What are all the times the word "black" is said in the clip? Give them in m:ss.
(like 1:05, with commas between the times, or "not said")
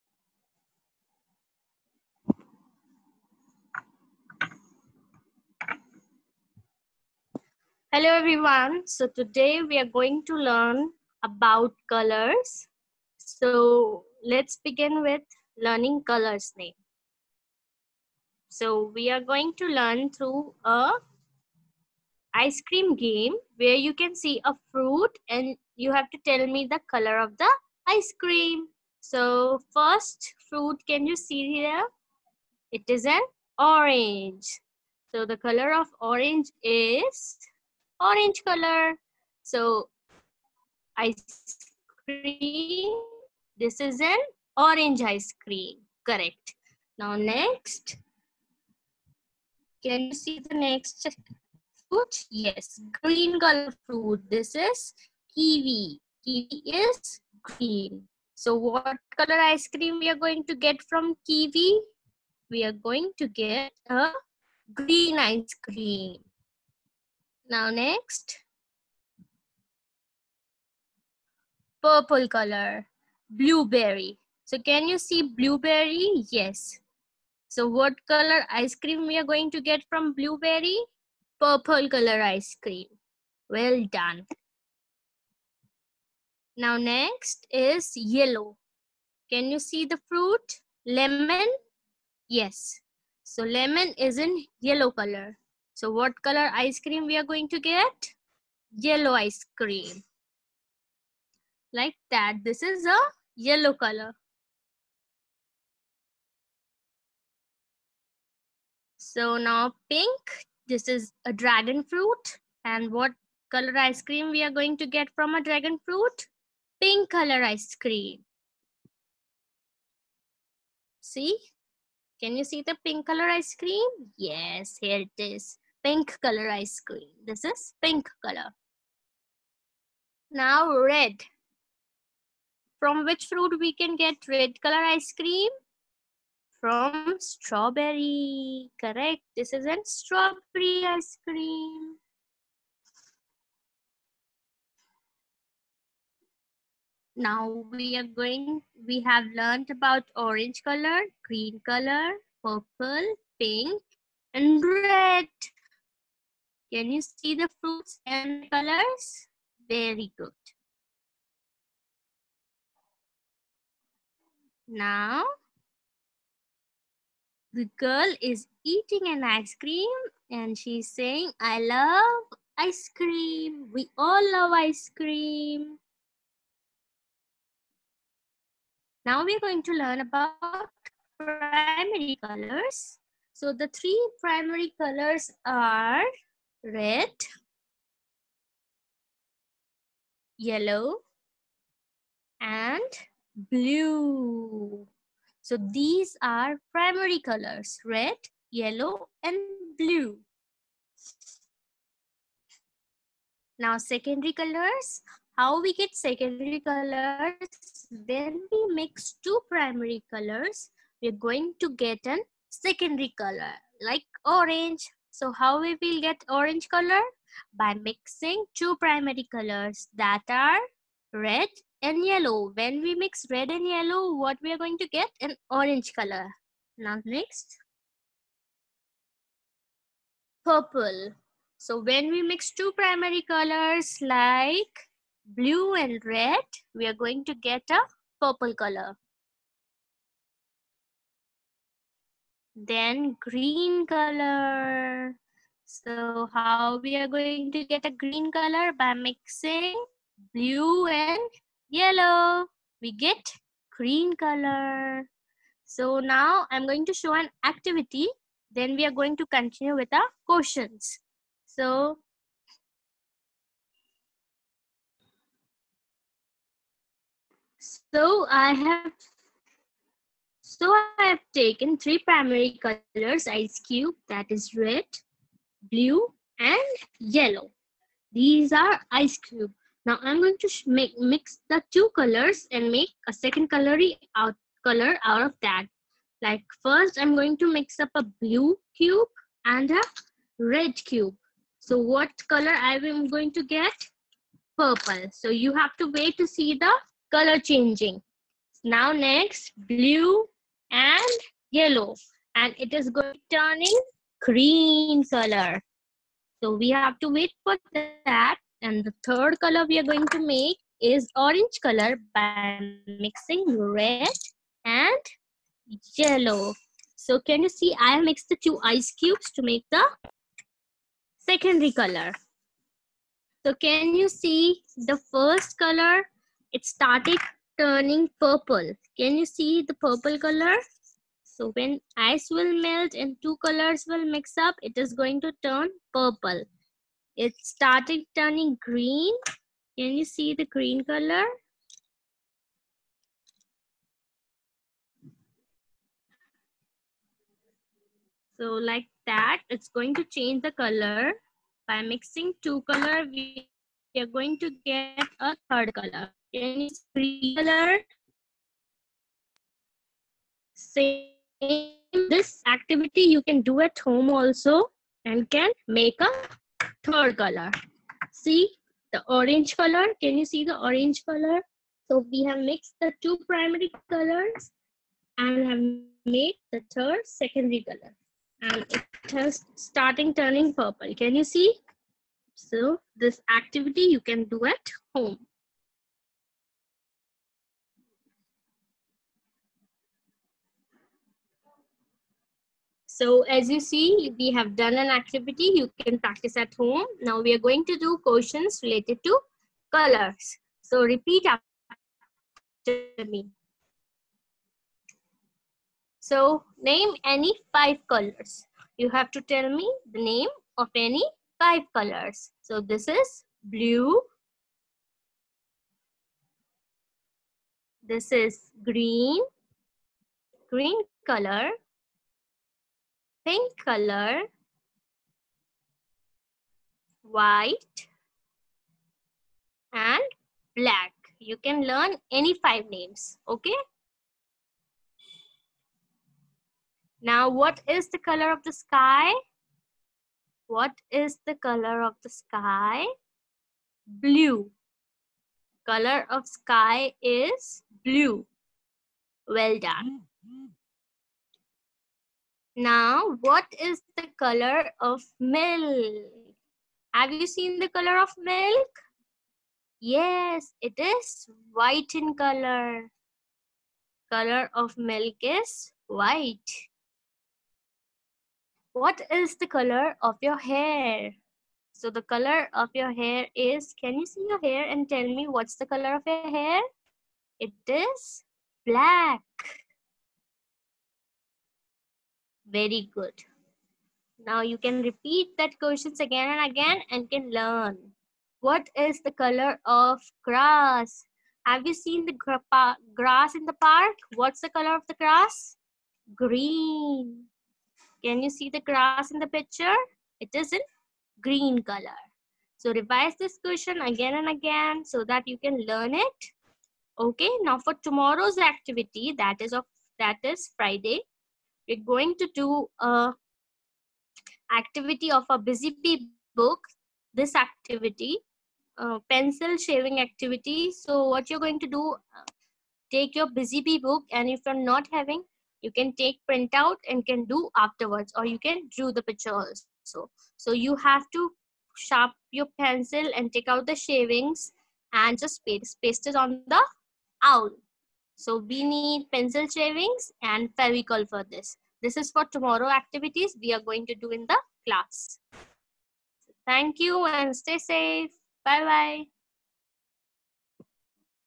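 7:10, 7:58.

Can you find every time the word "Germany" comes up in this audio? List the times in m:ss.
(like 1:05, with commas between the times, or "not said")
not said.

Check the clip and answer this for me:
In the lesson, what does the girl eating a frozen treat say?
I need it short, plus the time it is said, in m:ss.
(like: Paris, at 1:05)
I love ice cream, at 2:51.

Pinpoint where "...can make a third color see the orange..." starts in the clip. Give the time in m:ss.
6:05.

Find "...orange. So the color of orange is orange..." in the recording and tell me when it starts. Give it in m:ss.
0:33.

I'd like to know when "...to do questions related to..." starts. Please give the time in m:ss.
6:37.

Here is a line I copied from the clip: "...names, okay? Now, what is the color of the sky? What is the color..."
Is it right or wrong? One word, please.
right.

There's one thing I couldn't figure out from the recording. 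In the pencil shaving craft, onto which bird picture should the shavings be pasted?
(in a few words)
Owl.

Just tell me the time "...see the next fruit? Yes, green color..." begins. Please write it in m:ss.
0:50.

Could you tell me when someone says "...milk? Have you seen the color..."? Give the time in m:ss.
7:35.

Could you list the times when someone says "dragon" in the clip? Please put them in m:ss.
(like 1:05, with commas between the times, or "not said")
1:51, 1:55.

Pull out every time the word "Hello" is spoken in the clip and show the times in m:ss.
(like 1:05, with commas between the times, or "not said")
0:07.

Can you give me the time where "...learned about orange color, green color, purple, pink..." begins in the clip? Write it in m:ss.
2:29.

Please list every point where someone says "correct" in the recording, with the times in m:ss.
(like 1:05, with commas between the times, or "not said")
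0:46, 2:18.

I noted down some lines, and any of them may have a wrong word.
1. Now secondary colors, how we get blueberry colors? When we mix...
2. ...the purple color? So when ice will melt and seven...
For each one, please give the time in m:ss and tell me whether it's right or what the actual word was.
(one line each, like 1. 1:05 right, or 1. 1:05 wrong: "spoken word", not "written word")
1. 3:23 wrong: "secondary", not "blueberry"
2. 5:29 wrong: "two", not "seven".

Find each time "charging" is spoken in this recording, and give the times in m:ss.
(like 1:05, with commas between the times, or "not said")
not said.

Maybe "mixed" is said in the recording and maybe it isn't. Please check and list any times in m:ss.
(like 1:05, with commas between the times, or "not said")
5:18, 6:12.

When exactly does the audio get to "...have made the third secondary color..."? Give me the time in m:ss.
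6:15.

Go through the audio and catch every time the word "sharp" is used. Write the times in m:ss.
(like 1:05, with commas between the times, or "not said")
8:51.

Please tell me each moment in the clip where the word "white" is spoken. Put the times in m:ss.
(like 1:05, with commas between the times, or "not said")
7:07, 7:41, 7:45.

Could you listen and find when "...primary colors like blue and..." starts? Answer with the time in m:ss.
3:52.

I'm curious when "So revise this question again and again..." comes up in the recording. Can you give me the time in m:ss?
8:22.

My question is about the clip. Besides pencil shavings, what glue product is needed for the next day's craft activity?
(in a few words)
Fevicol.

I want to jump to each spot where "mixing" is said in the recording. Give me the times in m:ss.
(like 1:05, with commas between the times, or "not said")
3:37, 4:08, 5:12, 5:51.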